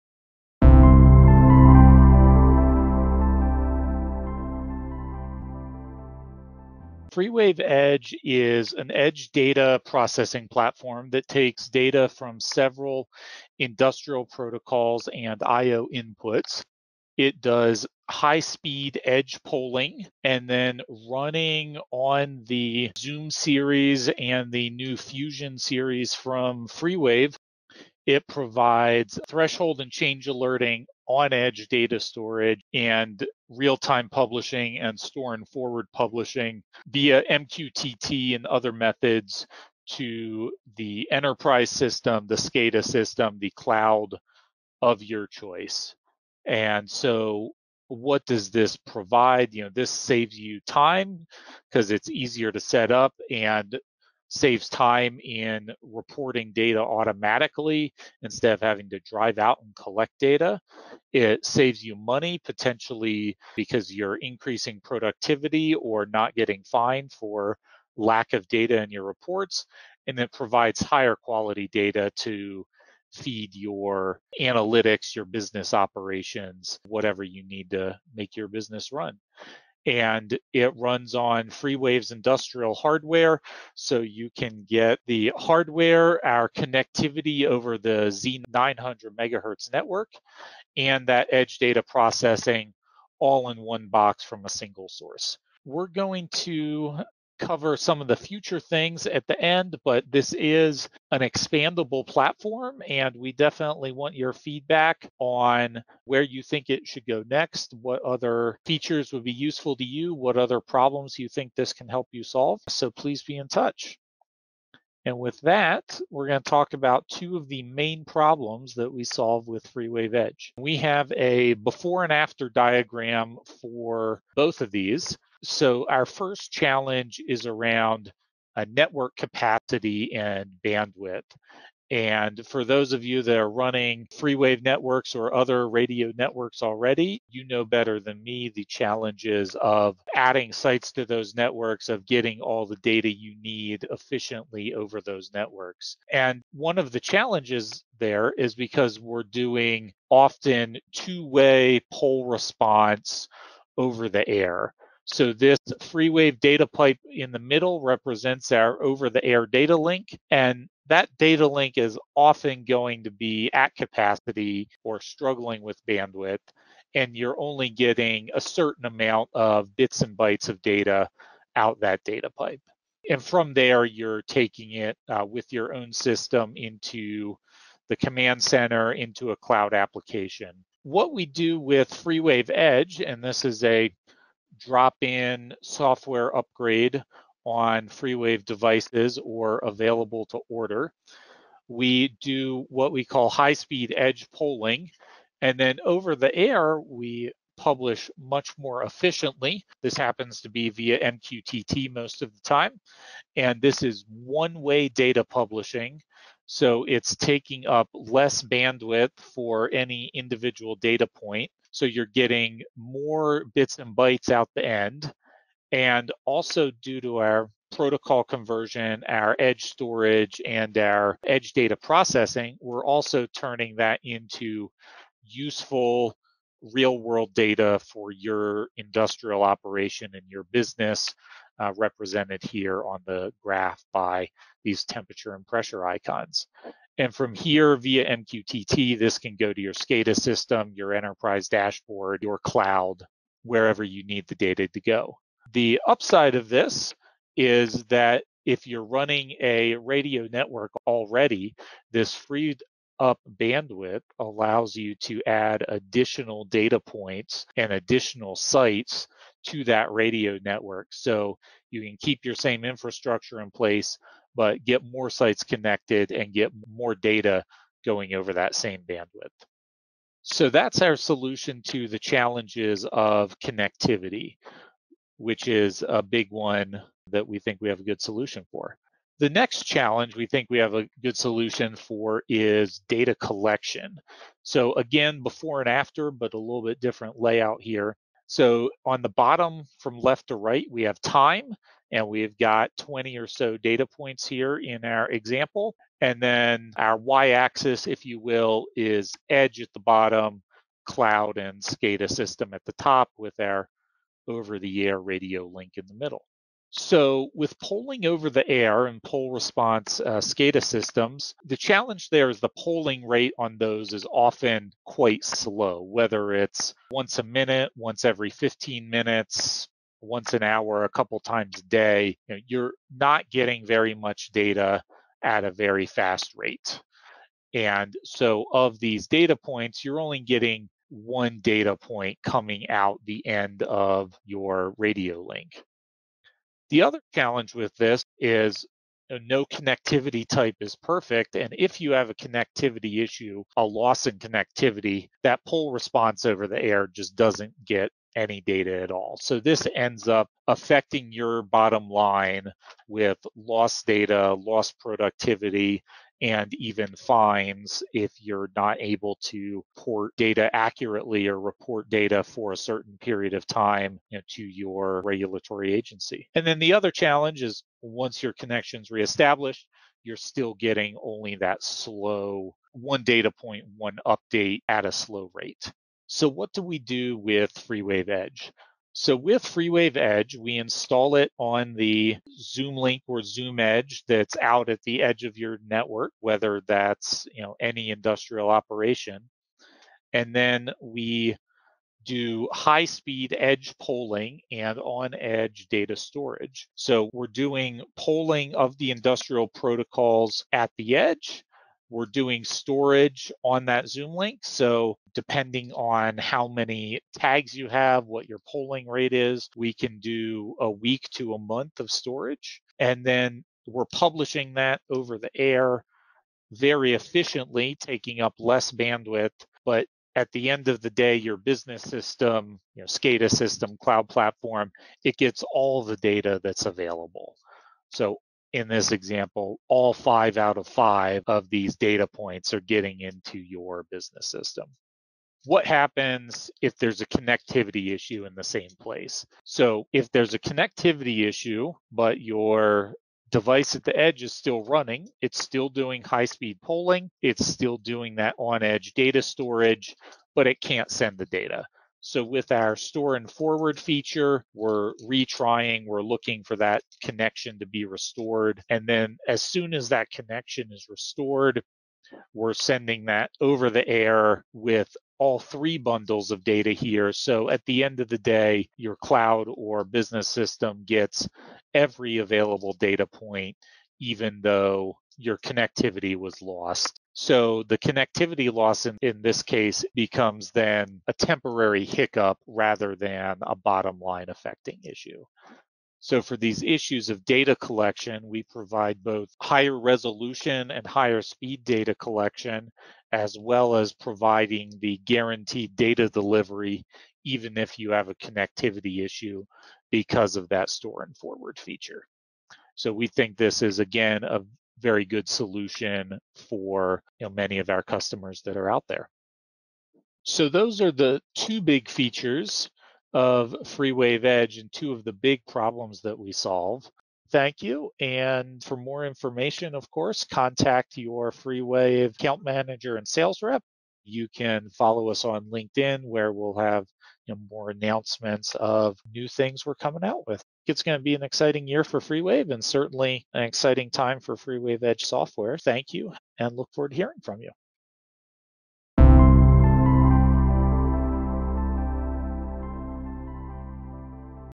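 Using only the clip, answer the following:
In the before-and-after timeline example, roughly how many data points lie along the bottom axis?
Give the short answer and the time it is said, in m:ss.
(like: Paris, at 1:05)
20, at 4:52.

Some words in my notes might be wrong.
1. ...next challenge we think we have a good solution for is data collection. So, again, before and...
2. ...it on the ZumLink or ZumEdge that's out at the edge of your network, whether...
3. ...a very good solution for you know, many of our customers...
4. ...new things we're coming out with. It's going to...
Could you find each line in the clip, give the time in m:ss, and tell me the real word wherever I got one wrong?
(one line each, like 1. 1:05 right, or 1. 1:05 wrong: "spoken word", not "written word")
1. 4:39 right
2. 6:21 right
3. 8:24 right
4. 8:49 right.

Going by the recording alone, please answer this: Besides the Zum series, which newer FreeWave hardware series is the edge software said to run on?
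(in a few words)
Fusion series.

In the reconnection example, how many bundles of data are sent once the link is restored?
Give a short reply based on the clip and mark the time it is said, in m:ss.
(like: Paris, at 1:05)
3, at 7:45.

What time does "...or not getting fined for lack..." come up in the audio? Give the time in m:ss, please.
1:05.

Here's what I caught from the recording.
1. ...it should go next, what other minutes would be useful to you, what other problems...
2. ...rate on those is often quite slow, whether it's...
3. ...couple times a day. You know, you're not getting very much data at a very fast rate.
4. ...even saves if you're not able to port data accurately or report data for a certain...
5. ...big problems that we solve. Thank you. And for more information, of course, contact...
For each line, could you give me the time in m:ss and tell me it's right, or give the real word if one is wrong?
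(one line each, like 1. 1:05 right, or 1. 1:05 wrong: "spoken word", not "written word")
1. 1:46 wrong: "features", not "minutes"
2. 5:13 right
3. 5:20 right
4. 5:56 wrong: "fines", not "saves"
5. 8:35 right.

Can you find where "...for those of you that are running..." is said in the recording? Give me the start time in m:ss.
2:12.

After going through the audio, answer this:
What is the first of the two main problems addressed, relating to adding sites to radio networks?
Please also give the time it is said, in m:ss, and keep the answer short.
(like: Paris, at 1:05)
Network capacity and bandwidth, at 2:08.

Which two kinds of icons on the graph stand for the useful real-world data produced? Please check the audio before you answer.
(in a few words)
Temperature and pressure.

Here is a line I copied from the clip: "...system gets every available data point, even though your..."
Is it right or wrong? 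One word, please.
right.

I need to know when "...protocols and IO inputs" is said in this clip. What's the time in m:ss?
0:14.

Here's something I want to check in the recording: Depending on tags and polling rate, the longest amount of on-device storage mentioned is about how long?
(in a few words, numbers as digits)
A month.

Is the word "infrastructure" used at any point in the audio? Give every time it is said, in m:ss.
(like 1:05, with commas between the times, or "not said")
4:22.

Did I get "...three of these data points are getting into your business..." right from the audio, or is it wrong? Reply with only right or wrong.
wrong.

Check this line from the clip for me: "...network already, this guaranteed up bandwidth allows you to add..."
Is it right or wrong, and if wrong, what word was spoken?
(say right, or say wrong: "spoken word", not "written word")
wrong: "freed", not "guaranteed".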